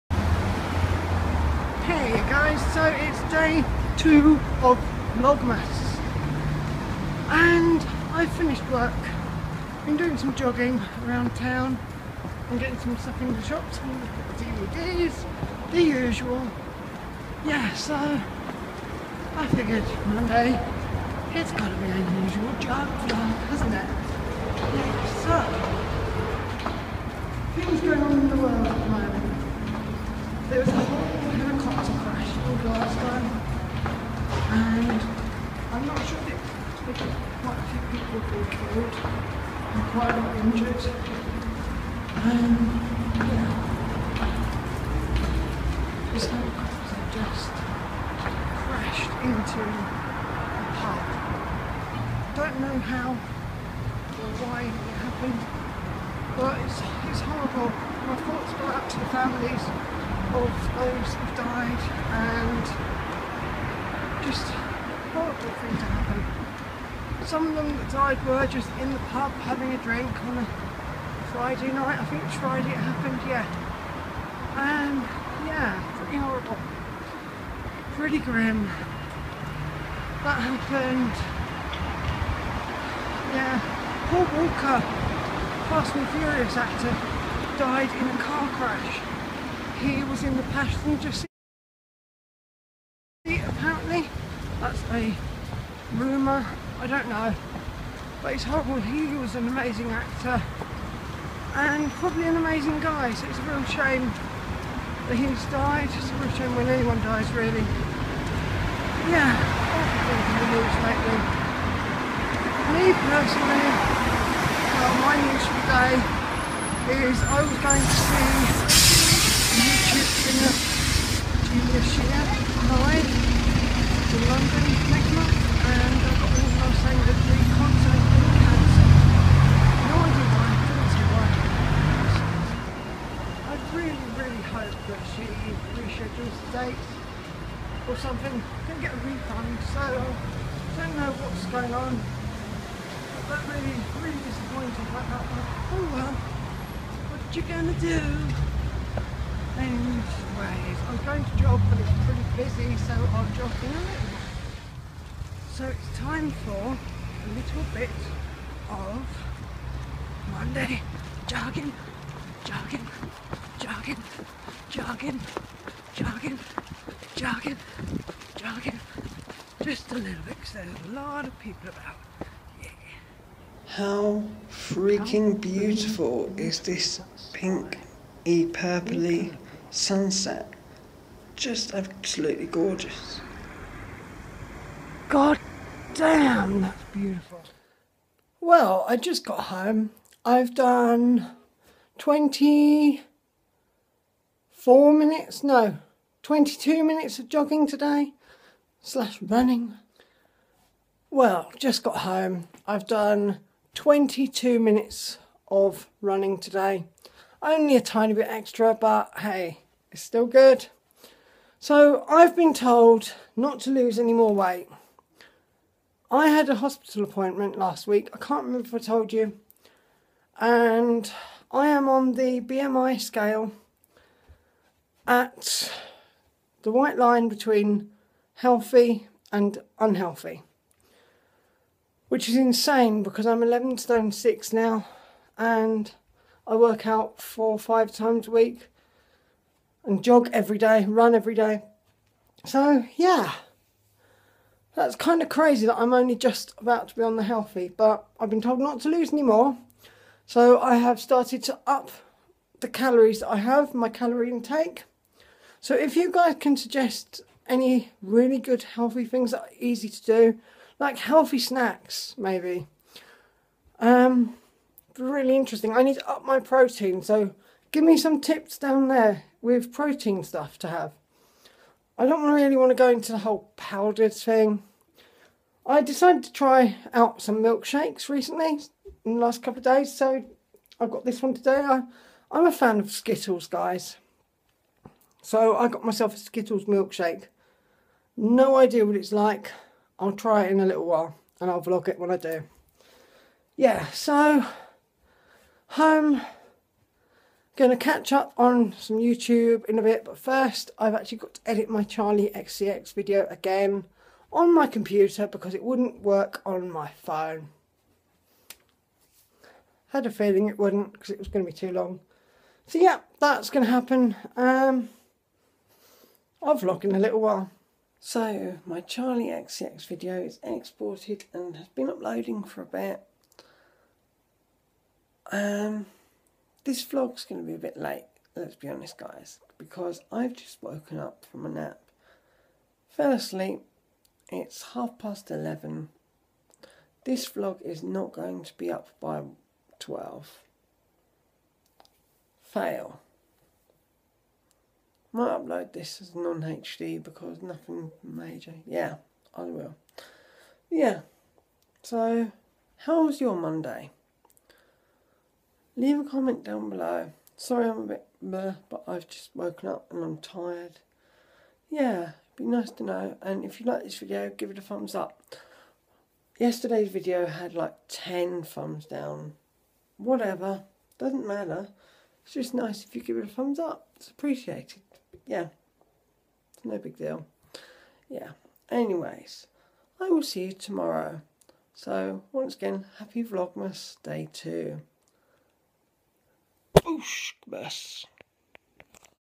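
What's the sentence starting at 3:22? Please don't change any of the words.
I've done 22 minutes of running today.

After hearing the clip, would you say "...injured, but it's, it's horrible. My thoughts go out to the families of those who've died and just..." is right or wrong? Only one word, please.
wrong.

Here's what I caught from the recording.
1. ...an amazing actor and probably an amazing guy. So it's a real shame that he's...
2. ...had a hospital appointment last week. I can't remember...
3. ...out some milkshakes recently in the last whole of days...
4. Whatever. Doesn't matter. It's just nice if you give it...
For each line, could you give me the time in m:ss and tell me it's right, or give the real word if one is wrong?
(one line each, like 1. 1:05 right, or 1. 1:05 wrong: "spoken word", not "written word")
1. 1:39 right
2. 3:36 right
3. 4:36 wrong: "couple", not "whole"
4. 6:09 right.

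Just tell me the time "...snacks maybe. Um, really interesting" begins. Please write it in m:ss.
4:21.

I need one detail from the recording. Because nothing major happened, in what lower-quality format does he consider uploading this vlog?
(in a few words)
non-HD.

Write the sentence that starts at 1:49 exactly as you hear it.
Yeah, awful things in the news lately.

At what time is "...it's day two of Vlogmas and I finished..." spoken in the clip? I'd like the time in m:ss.
0:02.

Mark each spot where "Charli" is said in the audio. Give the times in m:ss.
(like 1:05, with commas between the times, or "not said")
5:01, 5:18.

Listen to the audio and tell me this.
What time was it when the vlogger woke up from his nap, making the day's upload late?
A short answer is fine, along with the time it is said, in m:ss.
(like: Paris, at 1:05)
half past 11, at 5:34.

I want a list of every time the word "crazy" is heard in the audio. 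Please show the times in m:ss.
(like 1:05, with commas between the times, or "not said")
4:05.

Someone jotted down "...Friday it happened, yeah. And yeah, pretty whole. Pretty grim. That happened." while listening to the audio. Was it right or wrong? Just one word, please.
wrong.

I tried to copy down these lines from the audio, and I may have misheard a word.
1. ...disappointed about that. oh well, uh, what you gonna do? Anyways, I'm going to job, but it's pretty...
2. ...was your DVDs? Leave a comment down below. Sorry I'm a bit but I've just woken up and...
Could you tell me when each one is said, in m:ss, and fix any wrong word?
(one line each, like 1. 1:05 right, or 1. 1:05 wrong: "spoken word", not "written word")
1. 2:24 right
2. 5:53 wrong: "Monday", not "DVDs".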